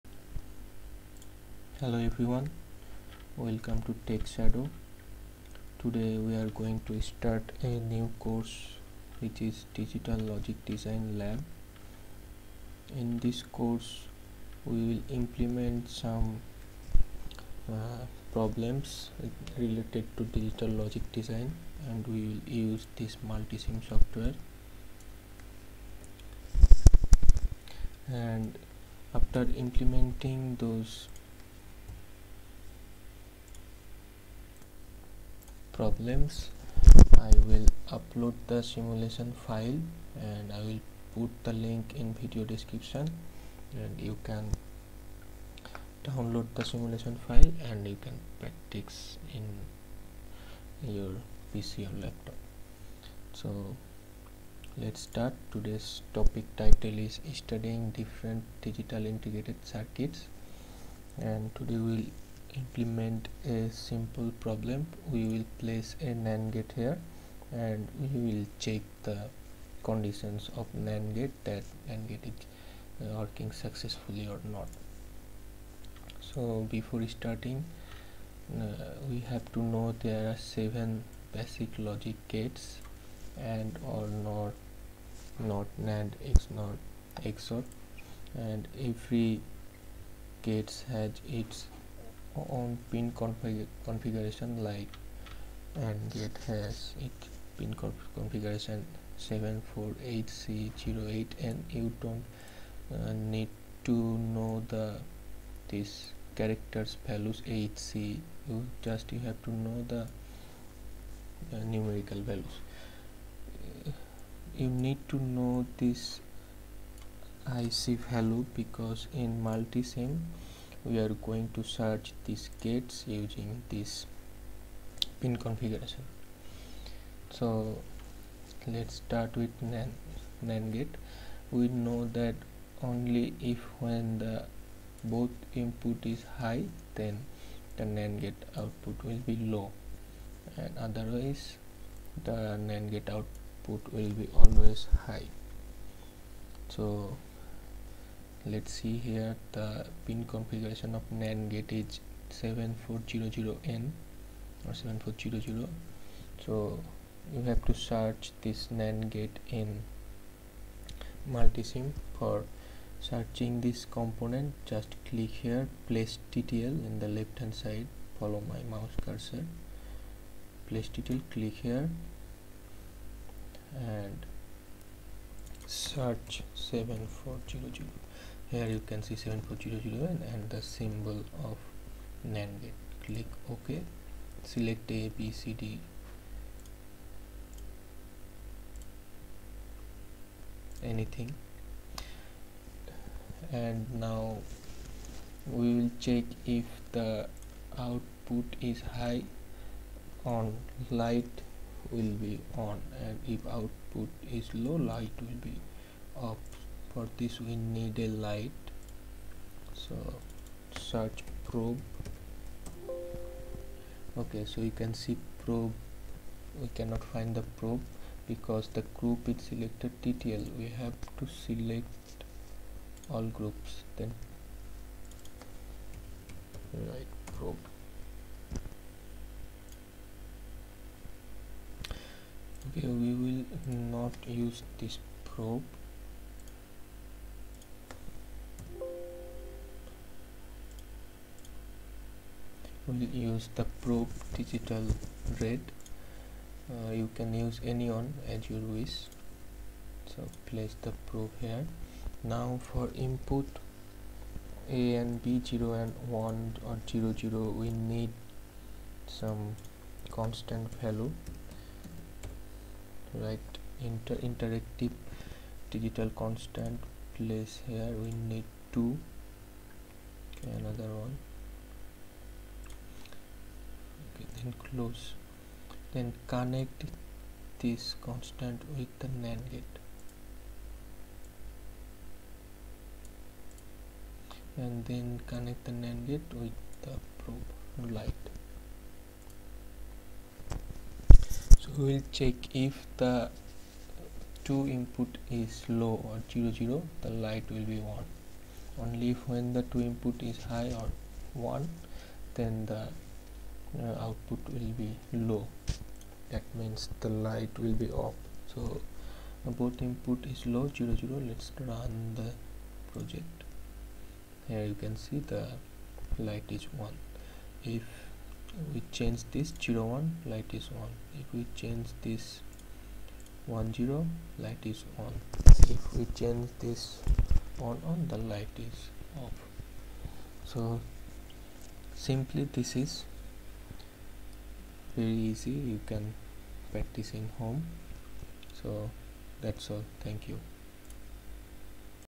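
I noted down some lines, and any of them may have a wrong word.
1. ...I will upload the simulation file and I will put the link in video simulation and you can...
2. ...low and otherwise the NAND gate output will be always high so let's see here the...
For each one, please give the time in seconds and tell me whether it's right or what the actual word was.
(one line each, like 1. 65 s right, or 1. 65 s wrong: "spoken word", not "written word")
1. 37 s wrong: "description", not "simulation"
2. 139 s right.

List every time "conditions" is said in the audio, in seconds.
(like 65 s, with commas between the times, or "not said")
69 s.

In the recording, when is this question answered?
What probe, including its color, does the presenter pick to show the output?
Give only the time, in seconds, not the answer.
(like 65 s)
244 s.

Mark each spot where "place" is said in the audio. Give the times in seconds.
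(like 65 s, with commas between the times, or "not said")
65 s, 165 s, 170 s, 250 s, 267 s.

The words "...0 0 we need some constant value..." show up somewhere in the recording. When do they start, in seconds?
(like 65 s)
256 s.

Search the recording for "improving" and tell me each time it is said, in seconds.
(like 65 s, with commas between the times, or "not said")
not said.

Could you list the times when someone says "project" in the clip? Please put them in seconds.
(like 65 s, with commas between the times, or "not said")
312 s.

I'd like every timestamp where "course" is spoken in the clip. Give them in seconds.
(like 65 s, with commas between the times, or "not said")
8 s, 13 s.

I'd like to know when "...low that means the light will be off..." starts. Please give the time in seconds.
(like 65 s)
305 s.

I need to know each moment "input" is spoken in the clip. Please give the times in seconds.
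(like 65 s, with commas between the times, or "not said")
135 s, 252 s, 294 s, 299 s, 309 s.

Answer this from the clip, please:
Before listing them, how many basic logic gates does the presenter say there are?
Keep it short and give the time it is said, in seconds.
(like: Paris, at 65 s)
7, at 80 s.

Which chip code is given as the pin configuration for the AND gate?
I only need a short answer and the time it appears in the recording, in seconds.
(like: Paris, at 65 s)
74HC08, at 99 s.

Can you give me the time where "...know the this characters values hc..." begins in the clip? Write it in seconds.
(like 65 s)
104 s.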